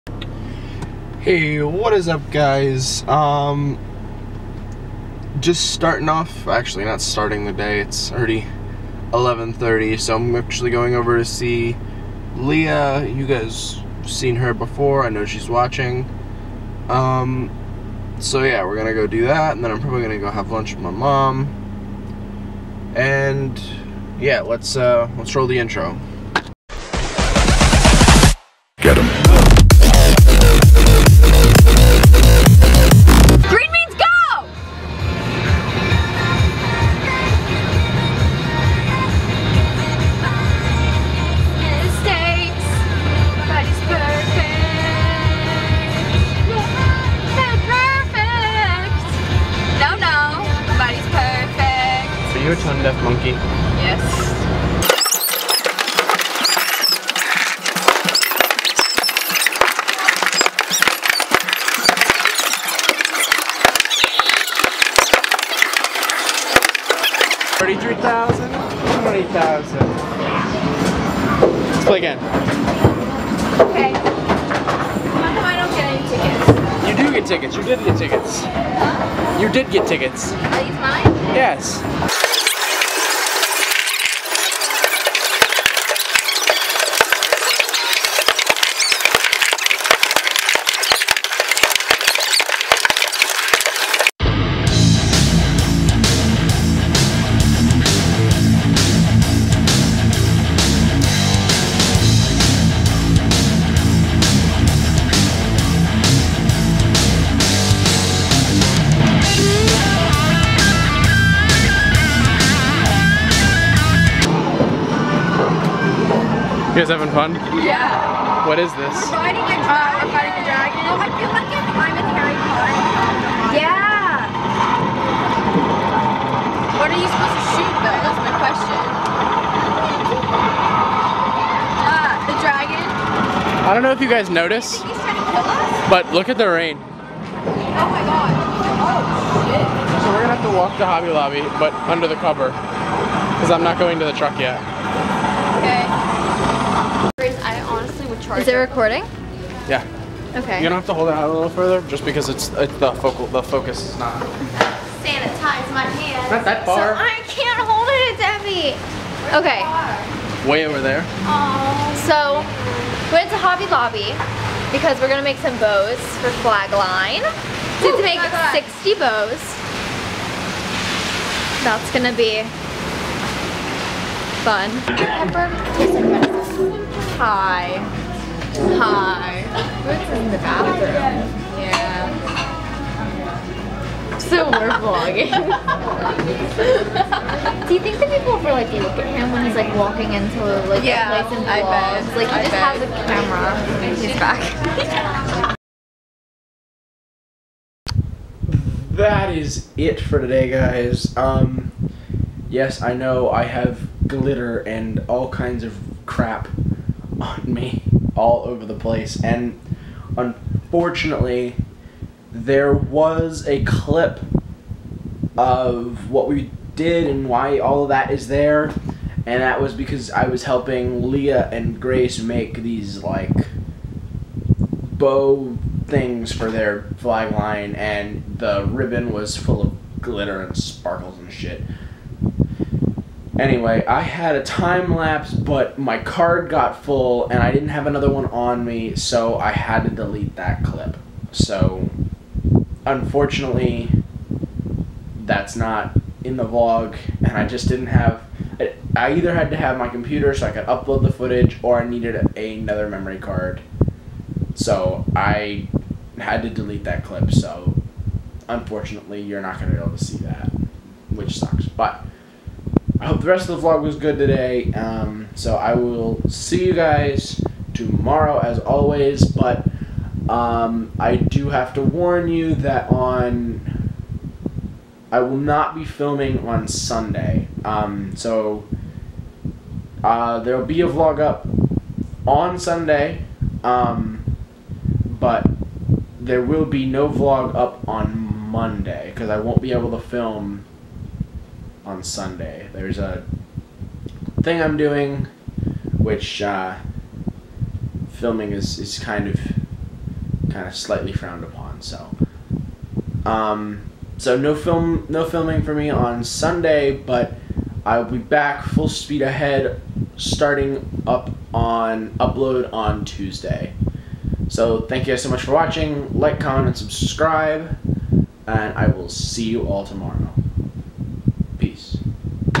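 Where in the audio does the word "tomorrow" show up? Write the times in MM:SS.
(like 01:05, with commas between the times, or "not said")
04:27, 05:19.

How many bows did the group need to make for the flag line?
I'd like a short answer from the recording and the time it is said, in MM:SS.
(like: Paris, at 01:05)
60, at 02:48.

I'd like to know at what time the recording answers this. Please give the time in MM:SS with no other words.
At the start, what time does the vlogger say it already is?
00:09.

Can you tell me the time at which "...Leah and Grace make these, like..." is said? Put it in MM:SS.
03:41.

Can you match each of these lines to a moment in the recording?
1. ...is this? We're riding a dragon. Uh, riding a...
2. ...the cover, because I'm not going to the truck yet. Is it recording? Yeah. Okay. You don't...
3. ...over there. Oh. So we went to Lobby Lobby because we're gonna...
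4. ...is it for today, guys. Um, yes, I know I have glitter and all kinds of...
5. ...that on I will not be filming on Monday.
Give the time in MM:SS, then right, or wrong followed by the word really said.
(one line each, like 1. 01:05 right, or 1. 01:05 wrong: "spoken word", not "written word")
1. 01:58 right
2. 02:22 right
3. 02:40 wrong: "Hobby", not "Lobby"
4. 03:19 right
5. 04:32 wrong: "Sunday", not "Monday".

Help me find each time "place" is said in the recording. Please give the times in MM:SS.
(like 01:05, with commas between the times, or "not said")
03:11, 03:28.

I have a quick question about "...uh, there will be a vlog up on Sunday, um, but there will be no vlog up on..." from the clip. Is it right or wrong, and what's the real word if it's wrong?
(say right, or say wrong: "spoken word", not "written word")
right.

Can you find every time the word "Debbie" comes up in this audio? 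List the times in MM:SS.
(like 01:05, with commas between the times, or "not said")
02:38.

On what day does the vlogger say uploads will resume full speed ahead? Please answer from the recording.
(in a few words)
Tuesday.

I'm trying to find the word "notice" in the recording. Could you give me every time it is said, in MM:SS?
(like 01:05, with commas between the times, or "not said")
02:14.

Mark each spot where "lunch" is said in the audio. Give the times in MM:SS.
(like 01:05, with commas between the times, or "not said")
00:20.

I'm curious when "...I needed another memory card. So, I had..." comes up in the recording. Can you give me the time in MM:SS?
04:11.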